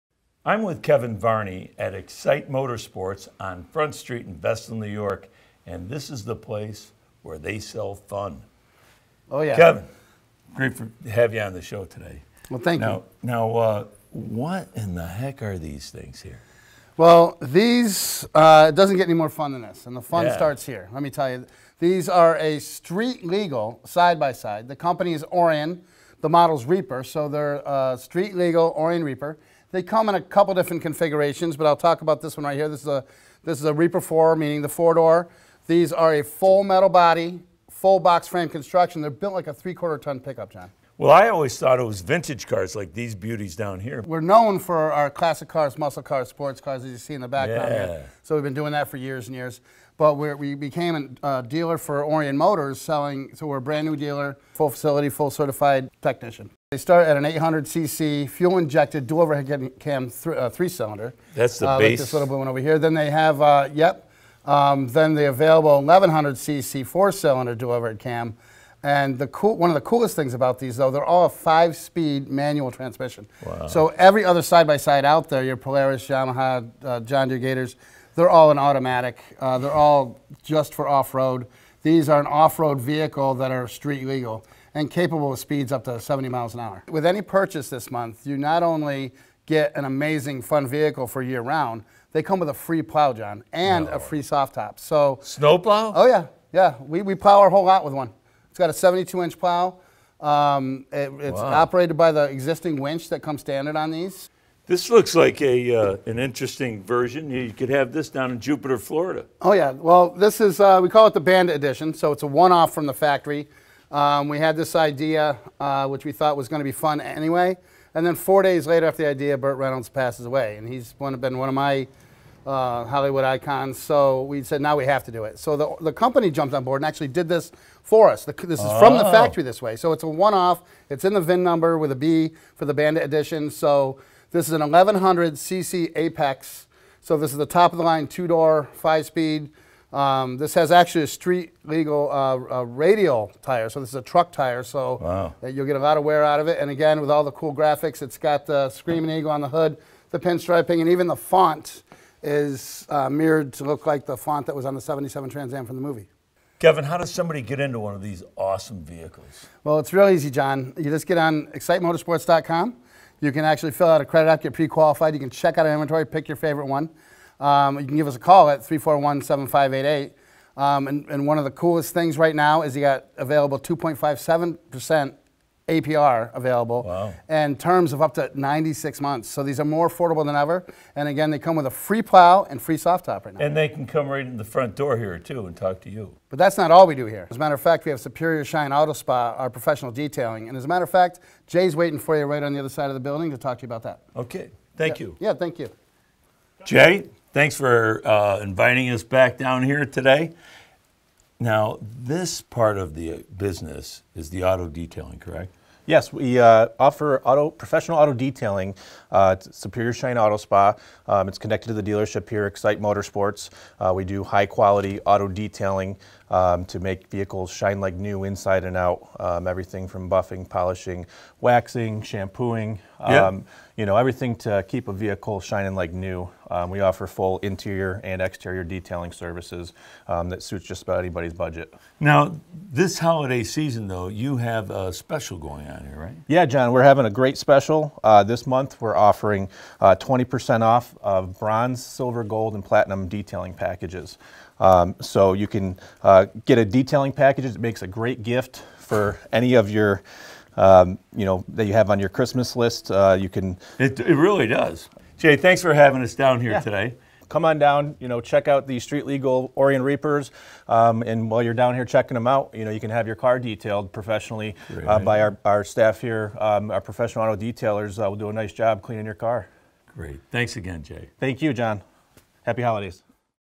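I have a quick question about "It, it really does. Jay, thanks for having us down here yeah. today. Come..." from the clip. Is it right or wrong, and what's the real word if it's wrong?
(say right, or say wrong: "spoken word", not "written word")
right.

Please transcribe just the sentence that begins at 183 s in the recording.
And they can come right in the front door here too and talk to you.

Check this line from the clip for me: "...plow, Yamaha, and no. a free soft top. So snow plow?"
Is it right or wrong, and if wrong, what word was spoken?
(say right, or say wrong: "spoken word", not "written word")
wrong: "John", not "Yamaha".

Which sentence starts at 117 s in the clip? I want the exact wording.
And then four days later after the idea, Burt Reynolds passes away.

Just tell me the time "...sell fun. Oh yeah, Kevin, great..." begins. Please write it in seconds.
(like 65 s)
7 s.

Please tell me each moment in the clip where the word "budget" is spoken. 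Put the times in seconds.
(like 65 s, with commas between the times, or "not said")
231 s.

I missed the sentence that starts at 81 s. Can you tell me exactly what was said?
These are an off road vehicle that are street legal and capable of speeds up to 70 miles an hour.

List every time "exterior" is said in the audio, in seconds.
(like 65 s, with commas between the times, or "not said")
228 s.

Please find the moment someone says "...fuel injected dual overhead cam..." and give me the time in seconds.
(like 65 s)
58 s.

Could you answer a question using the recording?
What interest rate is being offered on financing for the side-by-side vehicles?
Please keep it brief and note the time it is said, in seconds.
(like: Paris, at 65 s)
2.57% APR, at 173 s.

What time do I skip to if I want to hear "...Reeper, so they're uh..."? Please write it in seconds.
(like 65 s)
26 s.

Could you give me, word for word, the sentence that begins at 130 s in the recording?
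It's in the VIN number with a B for the Bandit Edition.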